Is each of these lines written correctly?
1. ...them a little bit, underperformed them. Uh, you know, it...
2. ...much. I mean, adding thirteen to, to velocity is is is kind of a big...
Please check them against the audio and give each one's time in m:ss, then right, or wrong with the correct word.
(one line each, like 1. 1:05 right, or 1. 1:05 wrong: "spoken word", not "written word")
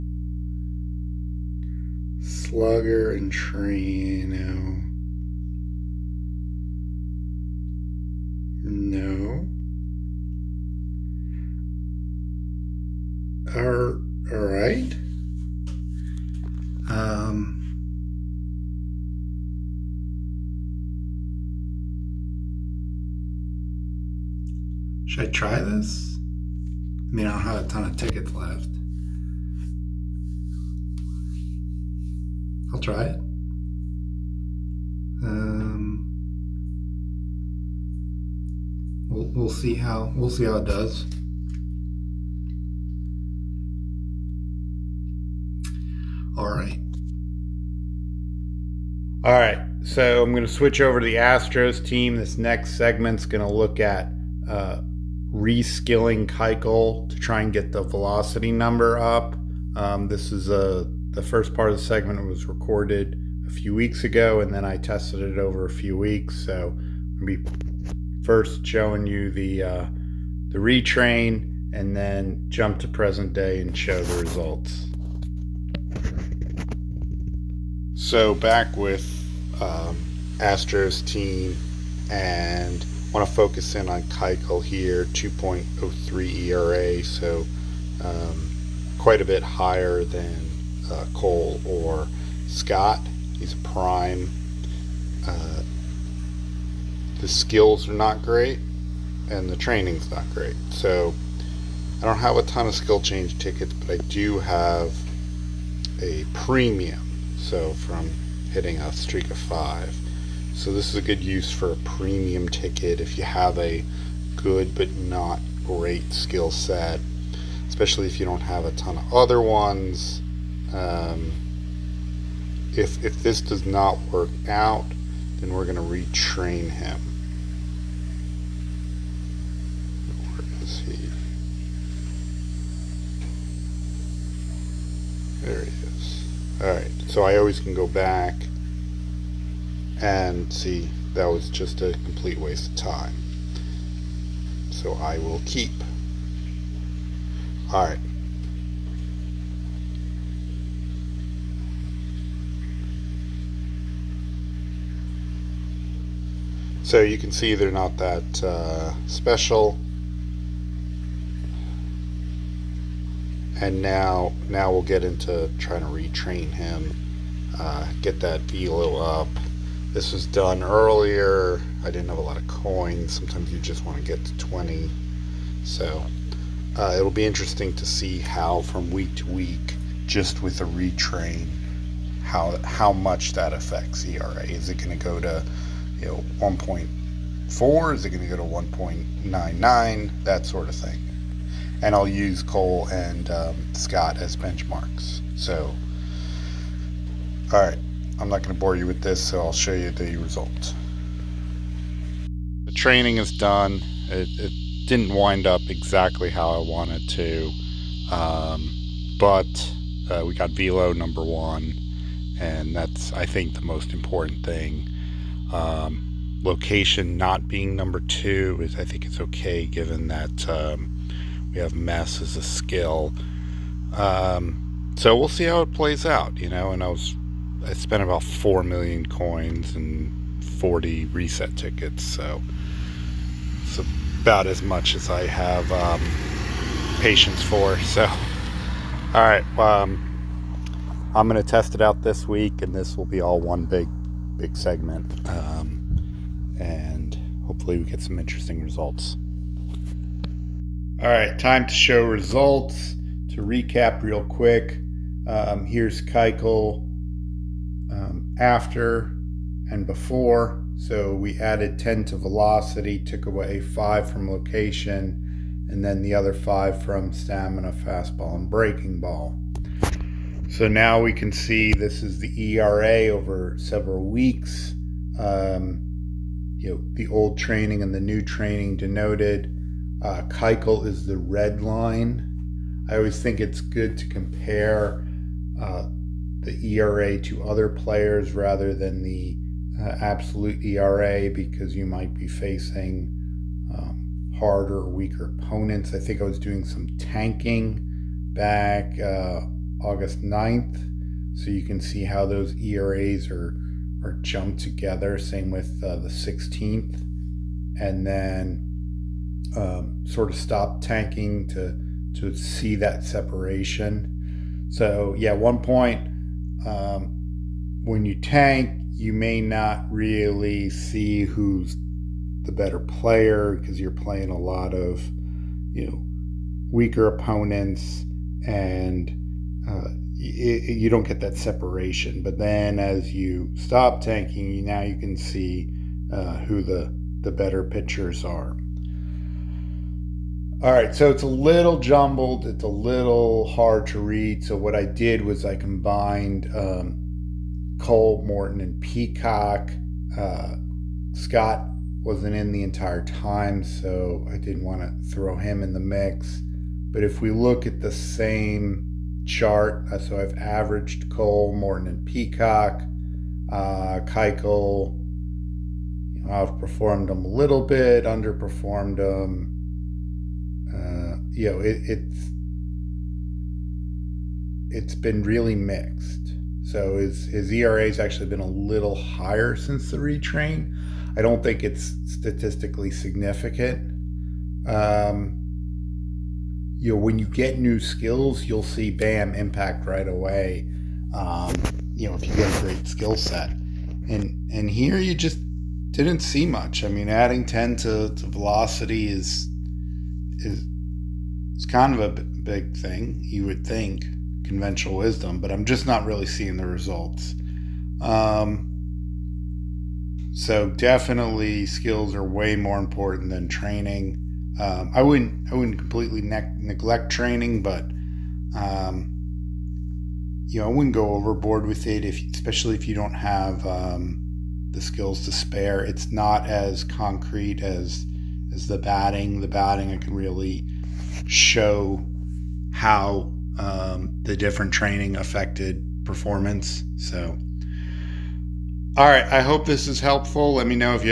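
1. 6:07 right
2. 6:36 wrong: "ten", not "thirteen".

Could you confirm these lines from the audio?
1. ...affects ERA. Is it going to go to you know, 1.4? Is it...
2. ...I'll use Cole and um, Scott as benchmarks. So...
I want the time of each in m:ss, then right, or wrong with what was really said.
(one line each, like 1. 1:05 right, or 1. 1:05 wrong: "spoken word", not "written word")
1. 3:03 right
2. 3:11 right.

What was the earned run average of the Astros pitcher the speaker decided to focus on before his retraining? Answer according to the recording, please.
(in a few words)
2.03.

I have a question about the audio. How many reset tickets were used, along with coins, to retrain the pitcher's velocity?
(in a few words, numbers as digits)
40.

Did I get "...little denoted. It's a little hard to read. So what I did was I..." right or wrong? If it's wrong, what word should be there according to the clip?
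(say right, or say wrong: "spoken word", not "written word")
wrong: "jumbled", not "denoted".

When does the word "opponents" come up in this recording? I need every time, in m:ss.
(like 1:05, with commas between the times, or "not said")
4:55, 5:27.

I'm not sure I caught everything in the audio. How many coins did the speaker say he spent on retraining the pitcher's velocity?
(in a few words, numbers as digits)
4 million.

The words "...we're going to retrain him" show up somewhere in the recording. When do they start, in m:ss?
2:05.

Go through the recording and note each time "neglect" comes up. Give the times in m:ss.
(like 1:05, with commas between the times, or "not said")
6:56.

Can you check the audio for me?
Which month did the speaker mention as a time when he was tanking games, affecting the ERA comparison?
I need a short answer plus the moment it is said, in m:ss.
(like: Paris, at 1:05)
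August, at 4:59.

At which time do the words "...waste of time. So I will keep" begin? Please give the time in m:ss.
2:22.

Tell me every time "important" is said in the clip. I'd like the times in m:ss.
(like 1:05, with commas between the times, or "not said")
3:33, 6:52.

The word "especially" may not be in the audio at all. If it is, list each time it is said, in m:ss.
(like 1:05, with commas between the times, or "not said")
1:57, 7:02.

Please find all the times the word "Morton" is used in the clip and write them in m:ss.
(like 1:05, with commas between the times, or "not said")
5:48, 6:01.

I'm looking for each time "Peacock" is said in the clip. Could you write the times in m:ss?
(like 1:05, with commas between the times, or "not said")
5:48, 6:02.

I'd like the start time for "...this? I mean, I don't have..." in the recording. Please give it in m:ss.
0:25.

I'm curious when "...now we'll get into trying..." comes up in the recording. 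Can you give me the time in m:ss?
2:44.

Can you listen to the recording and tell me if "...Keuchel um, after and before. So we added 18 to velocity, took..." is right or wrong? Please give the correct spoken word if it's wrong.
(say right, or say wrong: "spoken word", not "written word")
wrong: "10", not "18".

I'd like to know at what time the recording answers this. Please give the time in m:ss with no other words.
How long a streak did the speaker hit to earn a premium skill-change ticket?
1:48.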